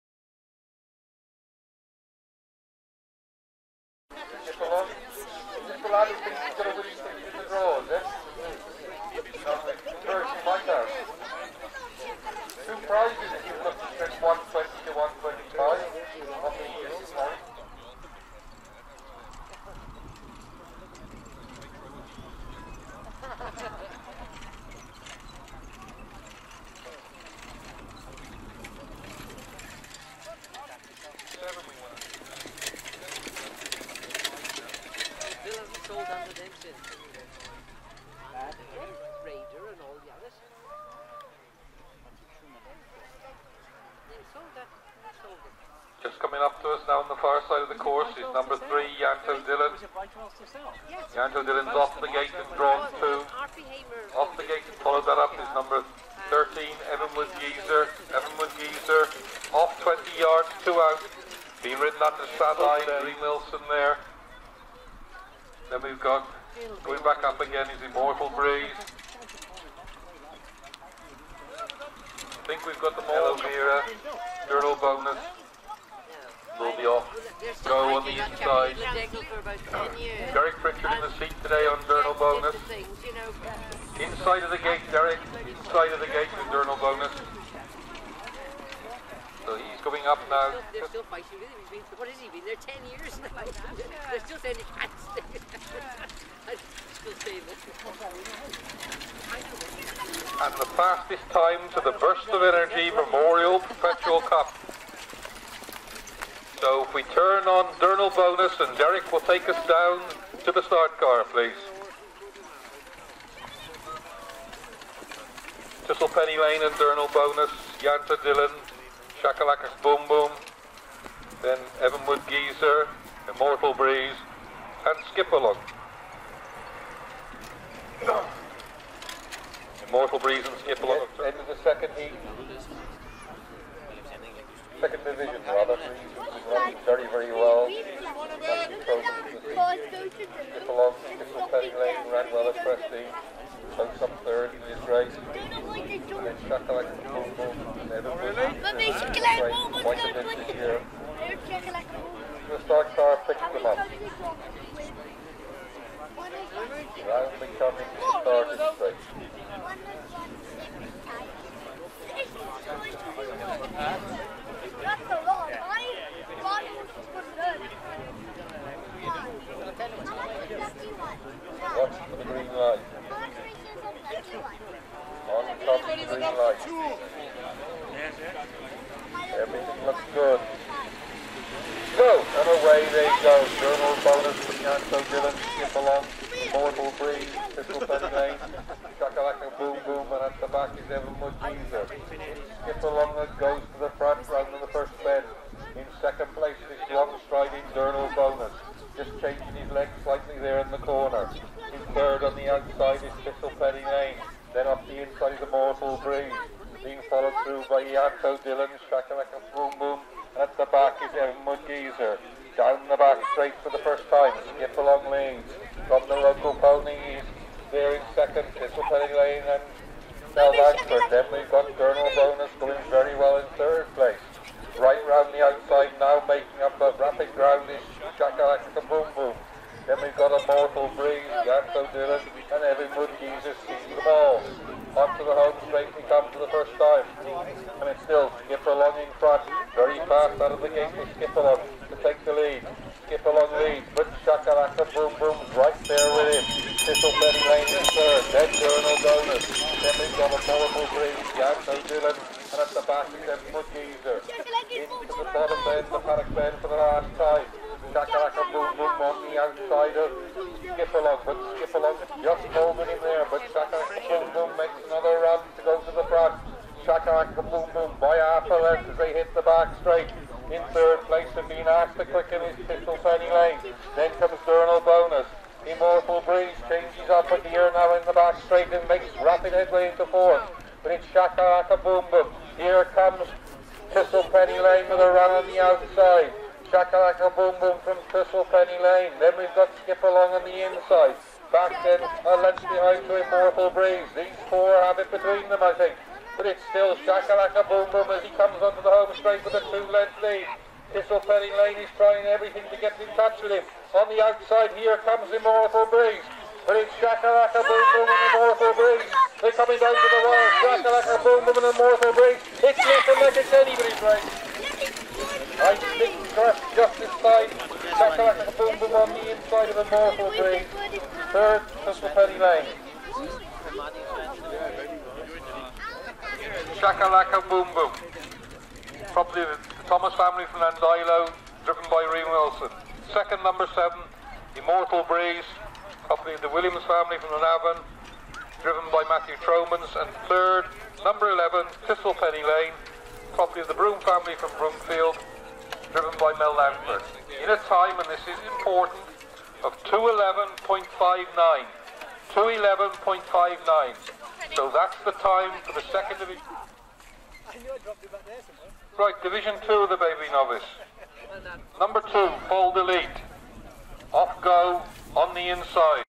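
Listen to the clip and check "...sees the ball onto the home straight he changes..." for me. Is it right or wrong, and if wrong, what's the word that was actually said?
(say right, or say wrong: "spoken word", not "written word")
wrong: "comes", not "changes".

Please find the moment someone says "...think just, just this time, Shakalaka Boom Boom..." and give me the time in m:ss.
5:15.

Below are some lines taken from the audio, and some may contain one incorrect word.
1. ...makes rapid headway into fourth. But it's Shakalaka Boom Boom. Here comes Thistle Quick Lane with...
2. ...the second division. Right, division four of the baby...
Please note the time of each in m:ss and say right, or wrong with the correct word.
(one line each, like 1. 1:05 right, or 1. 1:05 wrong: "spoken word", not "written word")
1. 4:38 wrong: "Penny", not "Quick"
2. 5:55 wrong: "two", not "four".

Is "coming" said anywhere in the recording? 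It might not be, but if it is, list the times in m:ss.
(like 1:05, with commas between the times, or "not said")
0:46, 5:09.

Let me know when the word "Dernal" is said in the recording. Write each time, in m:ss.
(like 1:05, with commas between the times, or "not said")
1:47, 1:56.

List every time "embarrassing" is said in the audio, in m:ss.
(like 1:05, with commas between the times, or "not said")
not said.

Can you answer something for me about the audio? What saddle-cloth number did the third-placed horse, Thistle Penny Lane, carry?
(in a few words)
11.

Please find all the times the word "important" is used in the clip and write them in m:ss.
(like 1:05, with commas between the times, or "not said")
5:48.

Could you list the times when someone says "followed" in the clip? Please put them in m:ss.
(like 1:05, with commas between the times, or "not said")
0:54, 3:27.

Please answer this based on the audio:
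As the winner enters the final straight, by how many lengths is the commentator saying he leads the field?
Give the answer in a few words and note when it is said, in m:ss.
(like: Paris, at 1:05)
2 lengths, at 4:59.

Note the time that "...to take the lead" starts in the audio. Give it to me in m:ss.
4:01.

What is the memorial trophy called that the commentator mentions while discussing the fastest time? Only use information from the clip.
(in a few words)
Burst of Energy Memorial Perpetual Cup.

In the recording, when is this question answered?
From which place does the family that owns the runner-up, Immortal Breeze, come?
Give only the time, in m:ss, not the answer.
5:37.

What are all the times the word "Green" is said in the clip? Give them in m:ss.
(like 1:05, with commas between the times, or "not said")
1:03, 4:10.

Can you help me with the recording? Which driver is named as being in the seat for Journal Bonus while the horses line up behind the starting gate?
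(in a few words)
Derek Pritchard.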